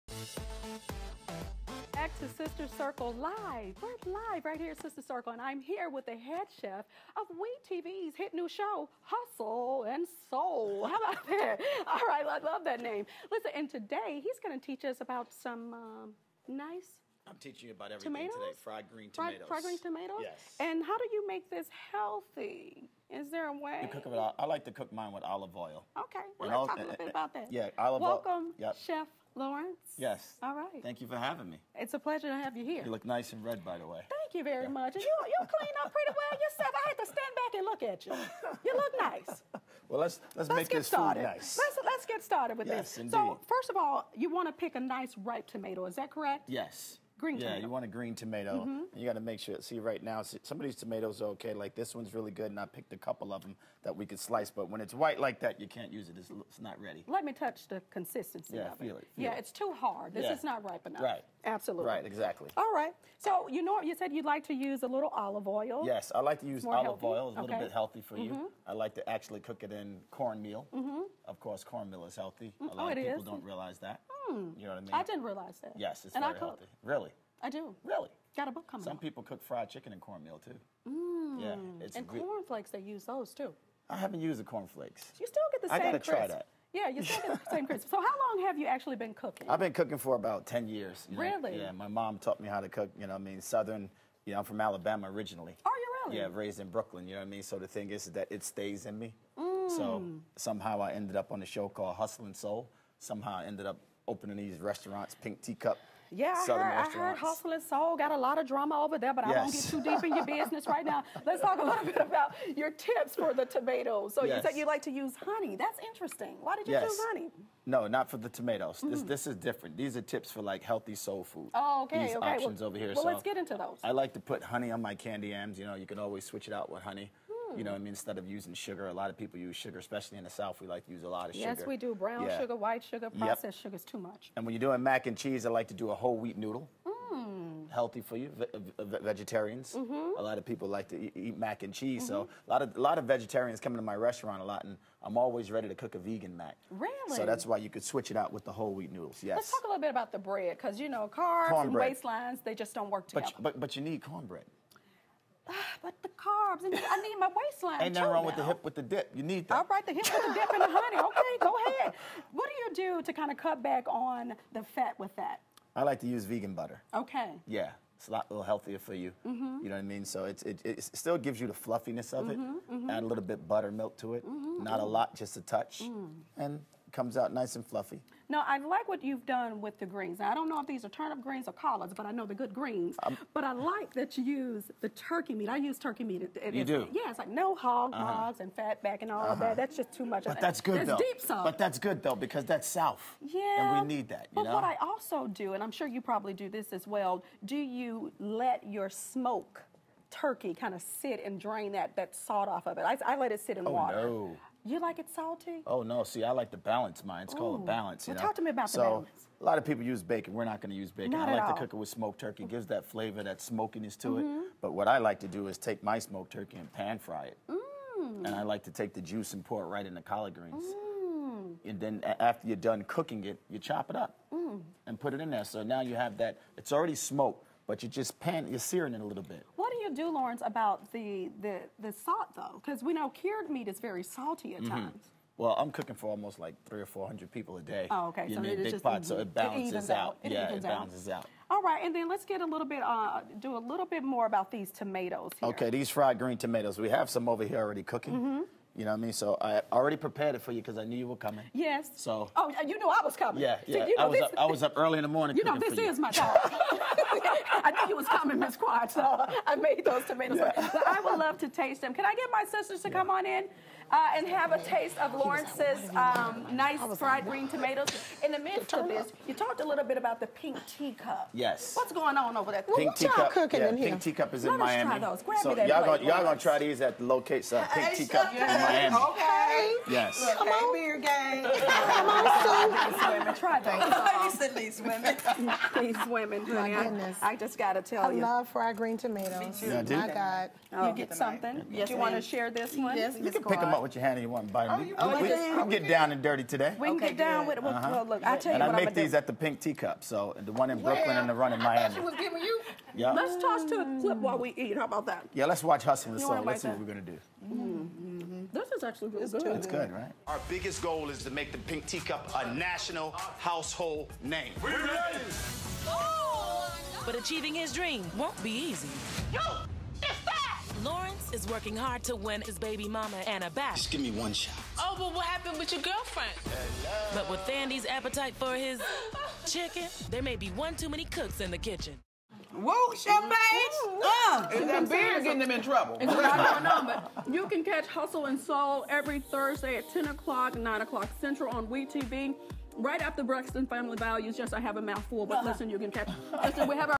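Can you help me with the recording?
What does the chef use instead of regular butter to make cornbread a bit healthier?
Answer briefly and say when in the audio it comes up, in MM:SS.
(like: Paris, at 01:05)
Vegan butter, at 02:46.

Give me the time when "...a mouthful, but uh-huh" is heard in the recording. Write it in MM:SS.
05:44.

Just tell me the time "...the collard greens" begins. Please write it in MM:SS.
03:39.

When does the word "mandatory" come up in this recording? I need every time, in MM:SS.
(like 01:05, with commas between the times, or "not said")
not said.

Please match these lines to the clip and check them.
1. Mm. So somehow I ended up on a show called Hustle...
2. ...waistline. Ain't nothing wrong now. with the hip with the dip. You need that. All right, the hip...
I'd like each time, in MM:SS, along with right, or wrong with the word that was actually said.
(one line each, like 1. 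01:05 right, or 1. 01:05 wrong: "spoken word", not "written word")
1. 01:39 right
2. 02:37 right.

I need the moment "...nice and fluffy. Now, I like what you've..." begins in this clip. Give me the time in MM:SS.
02:57.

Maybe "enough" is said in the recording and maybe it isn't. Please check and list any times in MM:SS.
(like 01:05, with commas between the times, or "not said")
01:00.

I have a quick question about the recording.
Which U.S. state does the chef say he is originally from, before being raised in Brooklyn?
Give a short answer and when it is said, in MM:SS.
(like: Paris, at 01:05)
Alabama, at 01:34.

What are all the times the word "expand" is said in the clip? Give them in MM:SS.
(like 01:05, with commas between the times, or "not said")
not said.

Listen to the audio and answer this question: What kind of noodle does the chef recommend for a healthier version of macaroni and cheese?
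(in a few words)
Whole wheat noodle.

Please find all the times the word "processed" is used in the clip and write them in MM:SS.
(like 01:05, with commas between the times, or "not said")
02:13.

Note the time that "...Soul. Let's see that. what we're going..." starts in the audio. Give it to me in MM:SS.
05:06.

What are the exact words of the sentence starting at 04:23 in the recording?
Uh, and have a taste of Lawrence's um, nice fried green tomatoes.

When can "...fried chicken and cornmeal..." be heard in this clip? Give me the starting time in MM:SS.
01:19.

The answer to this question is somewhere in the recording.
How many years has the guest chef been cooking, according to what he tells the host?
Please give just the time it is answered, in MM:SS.
01:30.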